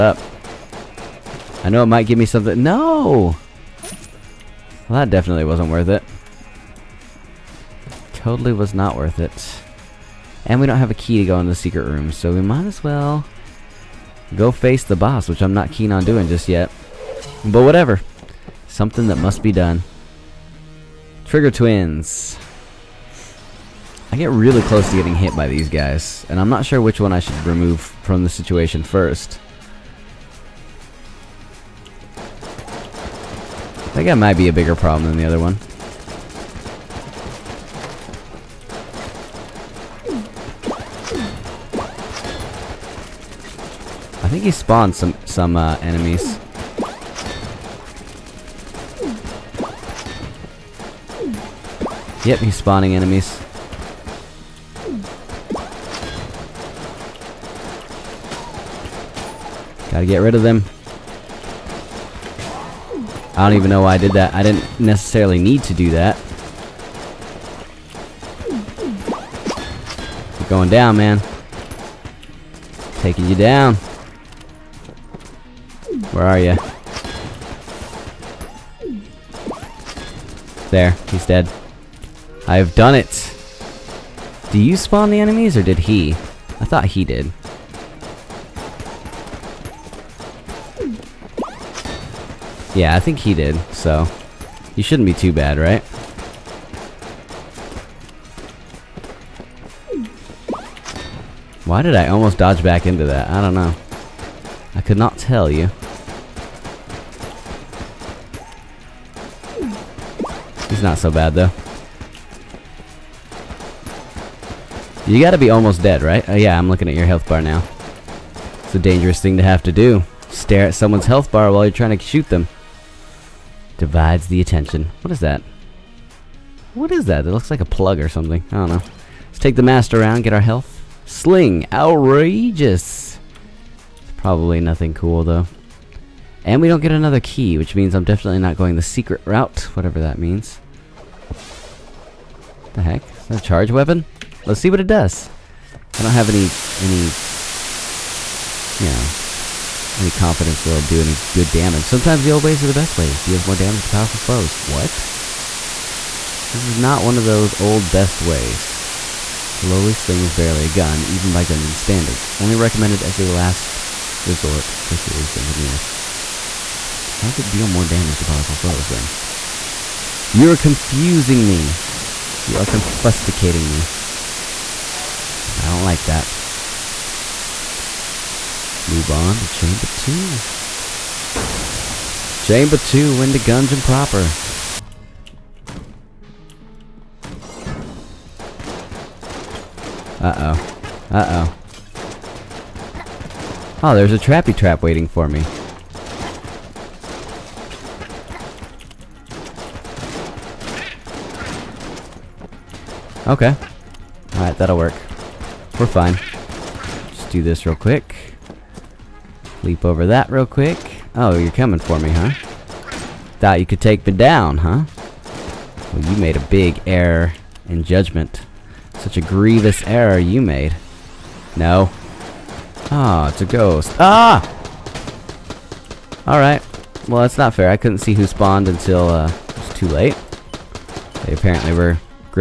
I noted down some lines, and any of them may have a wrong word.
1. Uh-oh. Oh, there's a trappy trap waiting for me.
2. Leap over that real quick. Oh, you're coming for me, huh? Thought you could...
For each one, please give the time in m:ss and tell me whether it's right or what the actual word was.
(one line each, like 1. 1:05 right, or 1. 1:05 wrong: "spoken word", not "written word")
1. 3:11 right
2. 3:29 right.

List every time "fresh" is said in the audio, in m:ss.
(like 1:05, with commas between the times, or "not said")
not said.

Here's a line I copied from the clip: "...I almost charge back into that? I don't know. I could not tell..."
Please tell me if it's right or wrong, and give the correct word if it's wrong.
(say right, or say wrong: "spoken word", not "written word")
wrong: "dodge", not "charge".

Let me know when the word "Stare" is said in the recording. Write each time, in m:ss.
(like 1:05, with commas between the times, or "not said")
2:00.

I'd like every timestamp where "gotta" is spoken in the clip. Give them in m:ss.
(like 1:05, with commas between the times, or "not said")
0:59, 1:55.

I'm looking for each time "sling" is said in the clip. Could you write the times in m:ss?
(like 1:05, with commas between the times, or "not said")
2:11, 2:39.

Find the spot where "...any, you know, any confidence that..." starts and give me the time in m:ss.
2:26.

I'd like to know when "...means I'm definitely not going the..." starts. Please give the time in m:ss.
2:17.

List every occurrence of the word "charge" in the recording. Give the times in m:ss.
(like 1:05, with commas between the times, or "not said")
2:23.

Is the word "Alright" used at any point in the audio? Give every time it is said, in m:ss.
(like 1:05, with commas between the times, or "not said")
3:24, 3:46.